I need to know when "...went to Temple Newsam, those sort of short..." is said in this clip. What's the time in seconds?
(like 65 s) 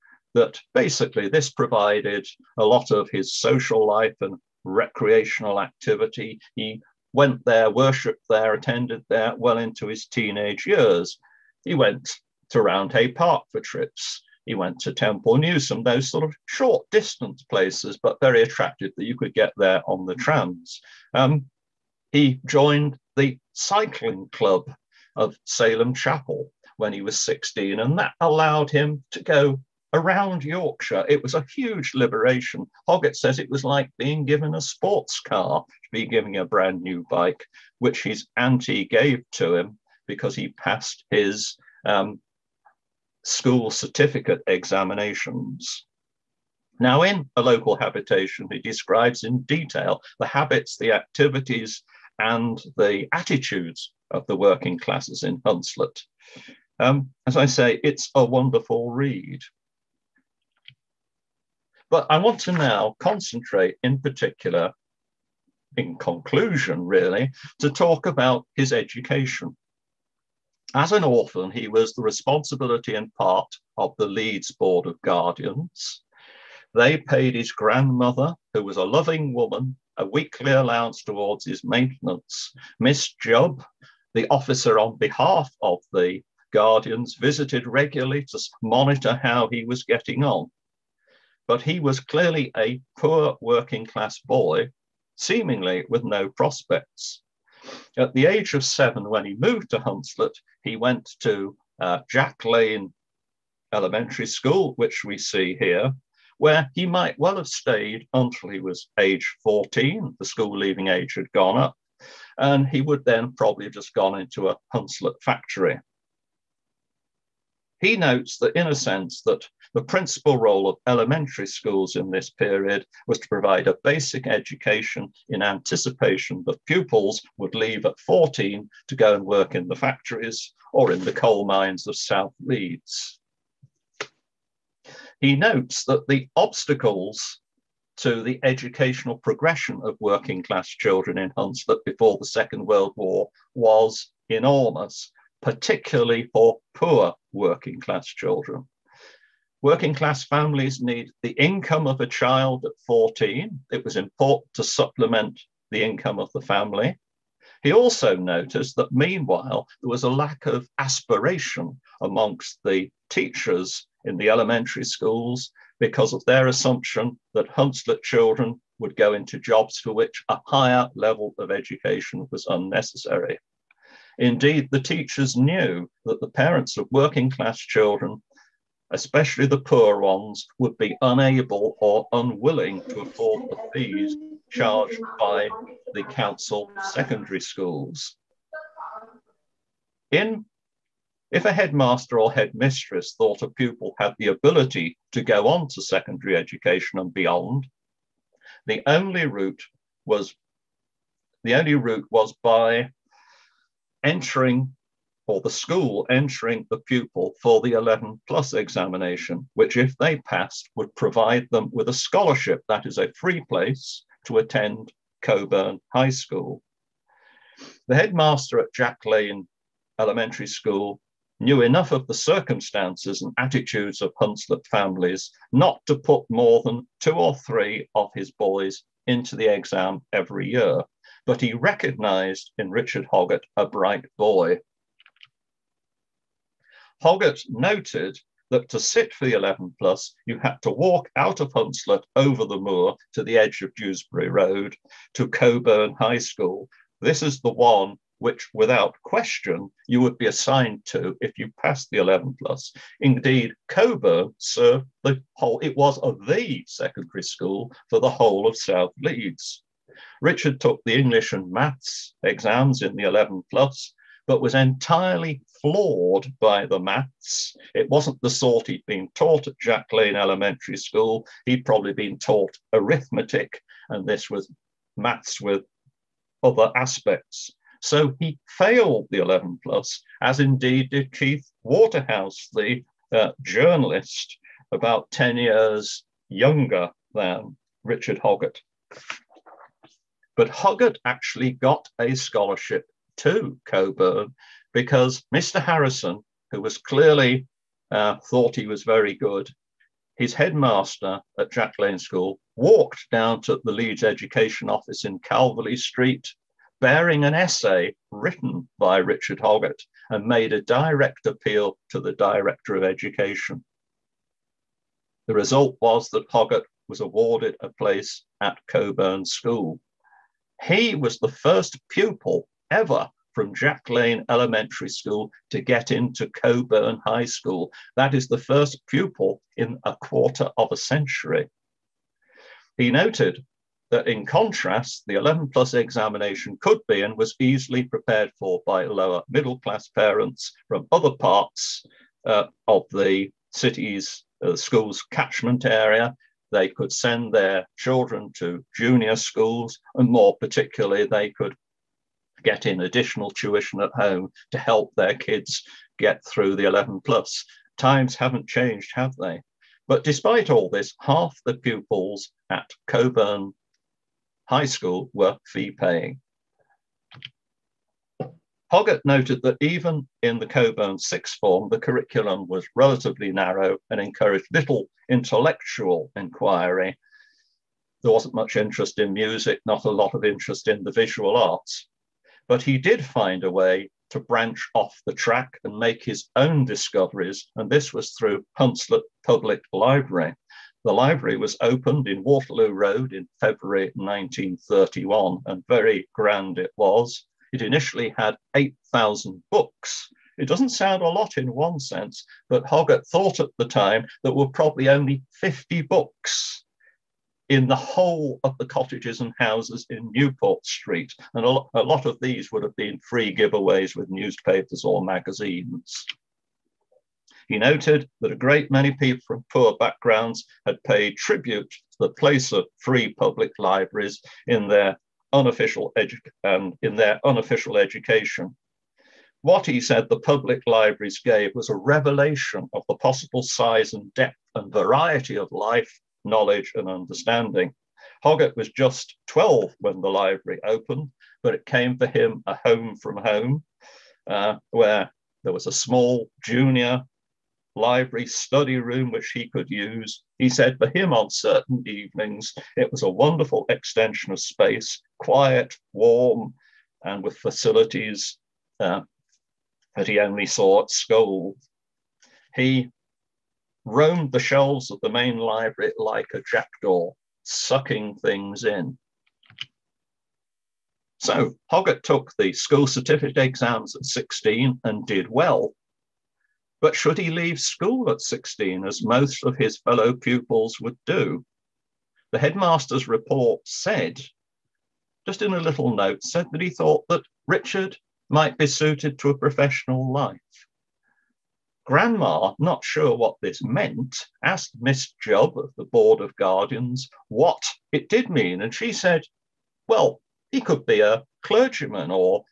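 14 s.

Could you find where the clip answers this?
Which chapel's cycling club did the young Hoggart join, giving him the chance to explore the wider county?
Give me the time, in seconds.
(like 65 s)
25 s.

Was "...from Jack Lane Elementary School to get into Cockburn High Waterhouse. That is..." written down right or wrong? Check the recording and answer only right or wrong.
wrong.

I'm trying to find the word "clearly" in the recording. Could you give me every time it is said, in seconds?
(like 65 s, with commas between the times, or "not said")
91 s, 296 s.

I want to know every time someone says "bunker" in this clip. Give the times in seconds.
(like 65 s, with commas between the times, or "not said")
not said.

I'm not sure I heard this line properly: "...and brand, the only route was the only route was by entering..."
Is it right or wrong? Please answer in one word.
wrong.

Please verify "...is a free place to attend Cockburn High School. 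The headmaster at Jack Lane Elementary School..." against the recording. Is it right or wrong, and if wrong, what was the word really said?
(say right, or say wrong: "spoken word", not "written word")
right.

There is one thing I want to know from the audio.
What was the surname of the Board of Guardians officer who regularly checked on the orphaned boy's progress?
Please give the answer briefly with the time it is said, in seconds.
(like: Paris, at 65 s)
Jubb, at 83 s.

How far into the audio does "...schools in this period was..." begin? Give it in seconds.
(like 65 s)
121 s.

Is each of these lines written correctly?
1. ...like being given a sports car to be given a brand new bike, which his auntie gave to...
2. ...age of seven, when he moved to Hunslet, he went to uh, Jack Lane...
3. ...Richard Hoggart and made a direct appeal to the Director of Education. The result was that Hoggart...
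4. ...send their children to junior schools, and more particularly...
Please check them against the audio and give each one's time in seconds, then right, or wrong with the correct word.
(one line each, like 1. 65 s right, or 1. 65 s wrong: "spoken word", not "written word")
1. 33 s right
2. 98 s right
3. 308 s right
4. 346 s right.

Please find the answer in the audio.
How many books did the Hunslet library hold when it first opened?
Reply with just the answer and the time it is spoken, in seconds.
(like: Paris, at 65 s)
8,000, at 398 s.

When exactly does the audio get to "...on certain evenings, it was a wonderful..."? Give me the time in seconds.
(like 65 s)
451 s.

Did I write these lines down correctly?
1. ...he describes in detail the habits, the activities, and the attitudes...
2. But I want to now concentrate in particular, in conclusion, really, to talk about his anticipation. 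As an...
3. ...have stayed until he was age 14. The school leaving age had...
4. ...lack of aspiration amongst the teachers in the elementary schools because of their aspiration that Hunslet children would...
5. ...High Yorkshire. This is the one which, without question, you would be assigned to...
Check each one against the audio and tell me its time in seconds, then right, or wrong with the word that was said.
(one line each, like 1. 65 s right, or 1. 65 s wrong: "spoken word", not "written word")
1. 48 s right
2. 61 s wrong: "education", not "anticipation"
3. 107 s right
4. 160 s wrong: "assumption", not "aspiration"
5. 245 s wrong: "School", not "Yorkshire".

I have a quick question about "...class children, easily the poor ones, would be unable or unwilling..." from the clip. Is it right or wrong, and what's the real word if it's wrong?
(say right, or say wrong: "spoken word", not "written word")
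wrong: "especially", not "easily".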